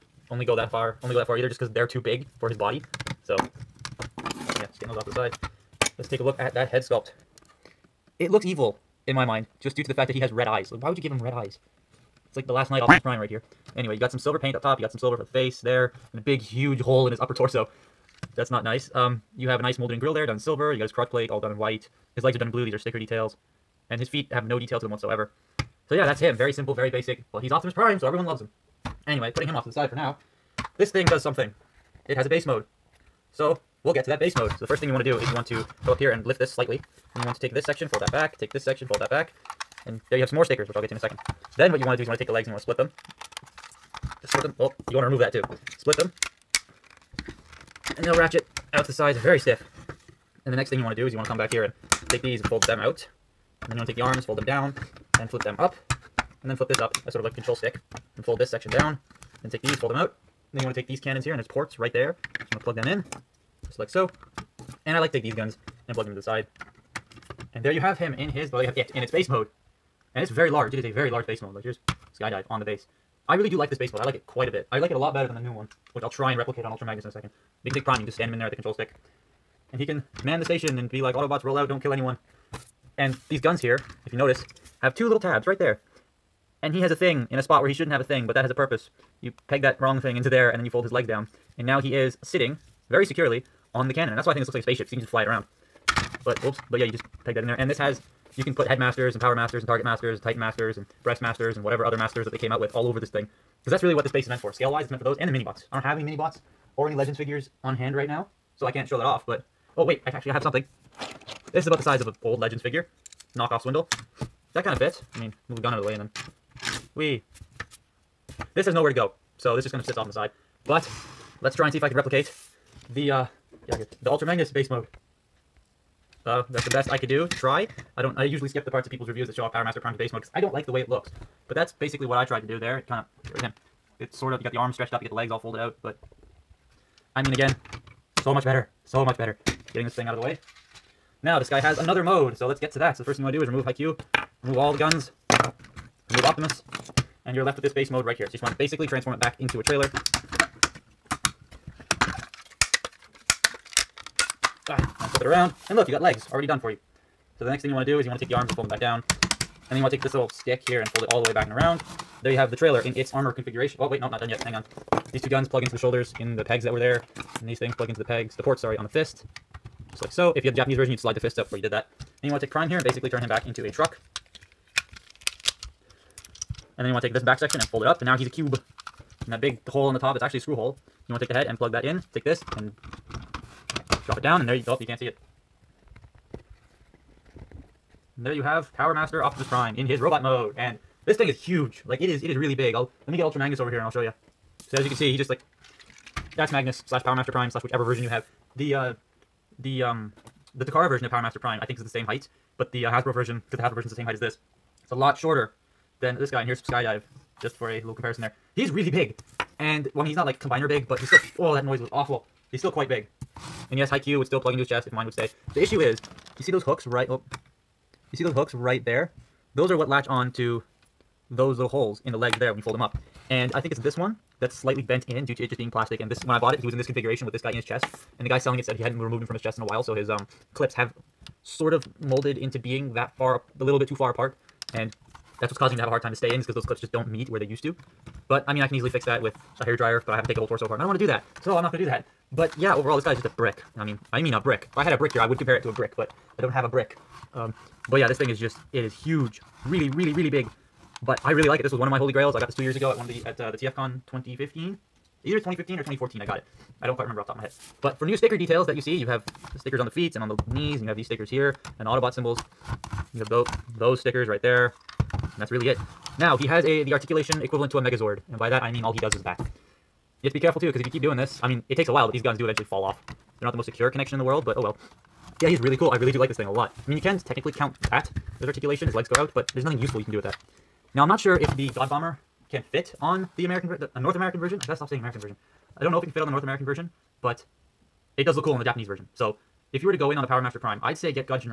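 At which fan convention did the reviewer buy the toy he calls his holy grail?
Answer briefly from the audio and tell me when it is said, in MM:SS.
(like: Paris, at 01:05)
TFCon, at 04:13.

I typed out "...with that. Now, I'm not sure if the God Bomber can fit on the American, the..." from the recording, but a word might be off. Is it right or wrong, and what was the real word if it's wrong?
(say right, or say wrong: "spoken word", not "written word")
right.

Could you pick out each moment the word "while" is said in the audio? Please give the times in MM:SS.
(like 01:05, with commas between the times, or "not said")
03:49, 04:31.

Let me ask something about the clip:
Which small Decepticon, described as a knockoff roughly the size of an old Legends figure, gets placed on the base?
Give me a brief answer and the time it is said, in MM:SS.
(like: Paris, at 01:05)
Swindle, at 01:53.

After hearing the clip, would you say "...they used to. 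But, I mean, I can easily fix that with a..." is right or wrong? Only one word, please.
right.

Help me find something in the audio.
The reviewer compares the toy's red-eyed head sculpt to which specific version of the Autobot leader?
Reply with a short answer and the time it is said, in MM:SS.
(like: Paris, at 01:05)
Last Knight Optimus Prime, at 00:12.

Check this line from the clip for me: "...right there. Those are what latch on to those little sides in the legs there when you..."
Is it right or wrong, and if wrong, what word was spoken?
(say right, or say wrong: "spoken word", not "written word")
wrong: "holes", not "sides".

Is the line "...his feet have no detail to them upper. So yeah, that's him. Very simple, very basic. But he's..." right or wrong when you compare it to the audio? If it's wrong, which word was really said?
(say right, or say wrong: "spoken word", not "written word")
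wrong: "whatsoever", not "upper".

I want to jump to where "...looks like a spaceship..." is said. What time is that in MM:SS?
01:34.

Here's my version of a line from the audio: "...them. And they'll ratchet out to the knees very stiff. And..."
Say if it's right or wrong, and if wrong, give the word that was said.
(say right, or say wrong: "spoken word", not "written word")
wrong: "sides", not "knees".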